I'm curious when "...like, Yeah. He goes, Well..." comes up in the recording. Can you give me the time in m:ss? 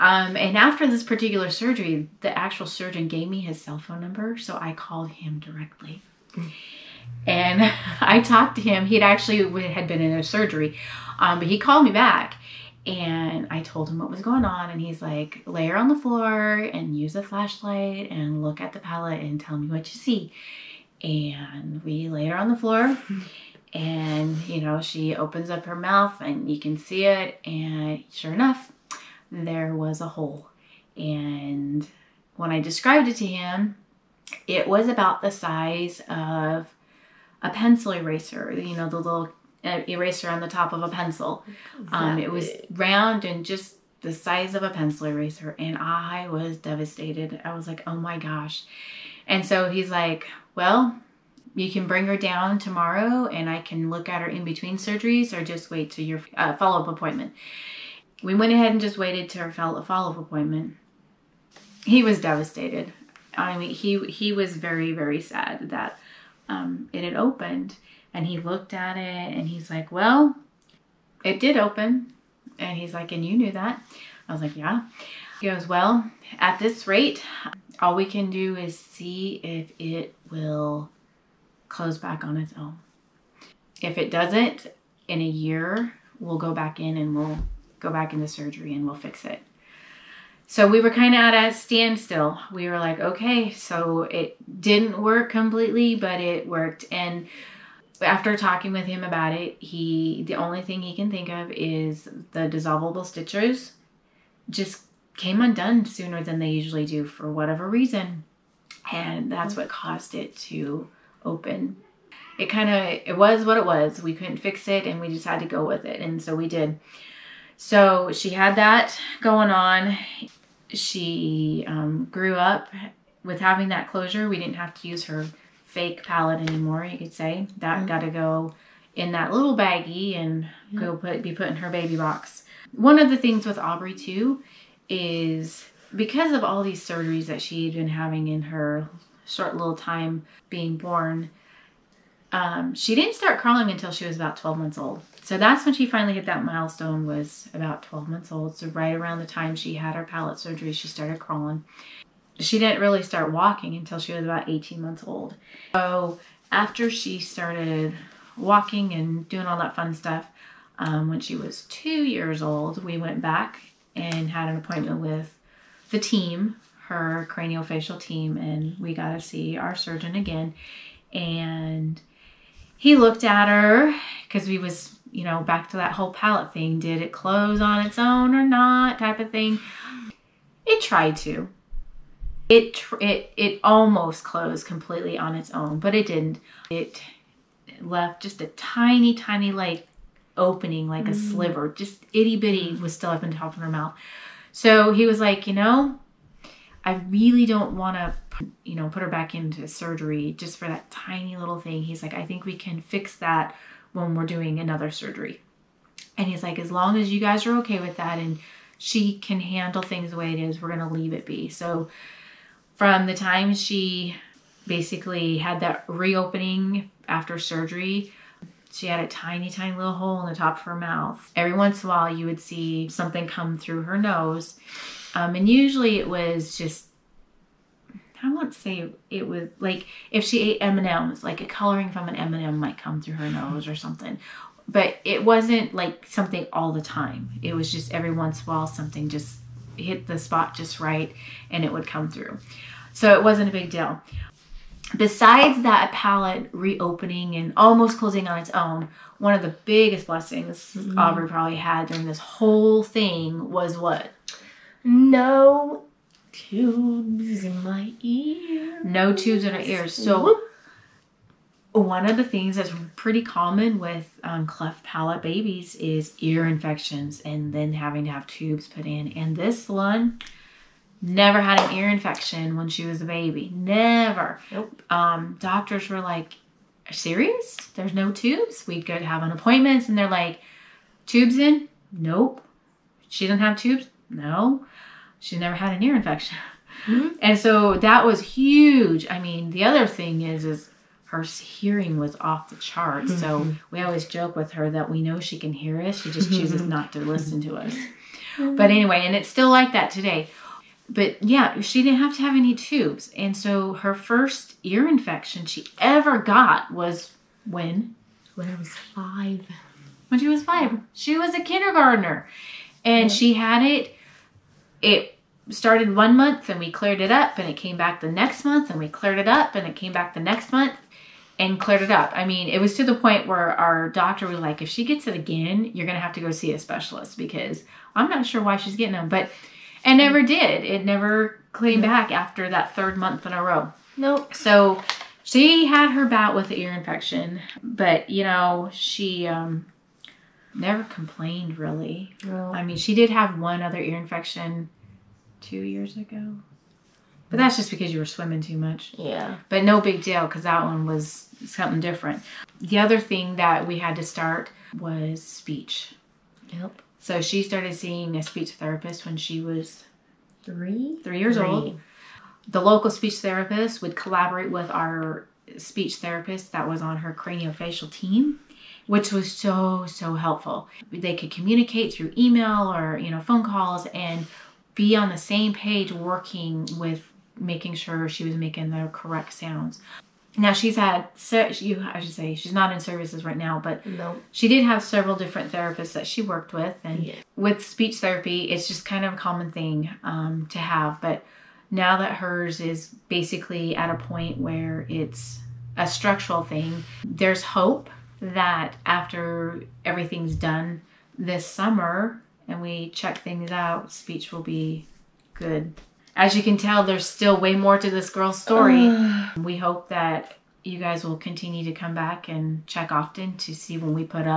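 1:14.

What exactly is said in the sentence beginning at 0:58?
We went ahead and just waited to her follow up appointment.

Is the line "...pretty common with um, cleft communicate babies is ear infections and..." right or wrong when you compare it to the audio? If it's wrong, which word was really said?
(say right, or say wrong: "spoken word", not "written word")
wrong: "palate", not "communicate".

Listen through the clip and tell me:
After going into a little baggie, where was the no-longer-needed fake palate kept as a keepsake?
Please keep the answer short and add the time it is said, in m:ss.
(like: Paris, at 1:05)
baby box, at 2:11.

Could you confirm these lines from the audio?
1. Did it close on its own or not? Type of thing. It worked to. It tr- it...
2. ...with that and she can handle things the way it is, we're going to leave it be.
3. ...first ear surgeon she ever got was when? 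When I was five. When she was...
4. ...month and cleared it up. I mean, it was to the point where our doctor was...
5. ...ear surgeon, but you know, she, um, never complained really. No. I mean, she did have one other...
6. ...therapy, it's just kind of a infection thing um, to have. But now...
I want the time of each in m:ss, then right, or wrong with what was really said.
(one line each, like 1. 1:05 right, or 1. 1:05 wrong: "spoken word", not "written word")
1. 2:56 wrong: "tried", not "worked"
2. 3:27 right
3. 5:03 wrong: "infection", not "surgeon"
4. 5:20 right
5. 5:36 wrong: "infection", not "surgeon"
6. 6:27 wrong: "common", not "infection".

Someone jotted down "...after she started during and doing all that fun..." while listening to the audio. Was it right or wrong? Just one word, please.
wrong.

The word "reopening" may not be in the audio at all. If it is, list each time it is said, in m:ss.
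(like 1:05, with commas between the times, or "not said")
3:35, 4:06.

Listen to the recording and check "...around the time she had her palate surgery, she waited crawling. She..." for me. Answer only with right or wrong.
wrong.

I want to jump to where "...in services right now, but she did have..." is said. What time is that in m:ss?
6:22.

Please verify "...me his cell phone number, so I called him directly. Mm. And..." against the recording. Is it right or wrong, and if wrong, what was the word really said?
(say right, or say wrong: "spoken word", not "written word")
right.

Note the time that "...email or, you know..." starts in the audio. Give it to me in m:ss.
6:12.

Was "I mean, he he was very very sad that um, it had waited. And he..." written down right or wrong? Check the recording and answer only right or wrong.
wrong.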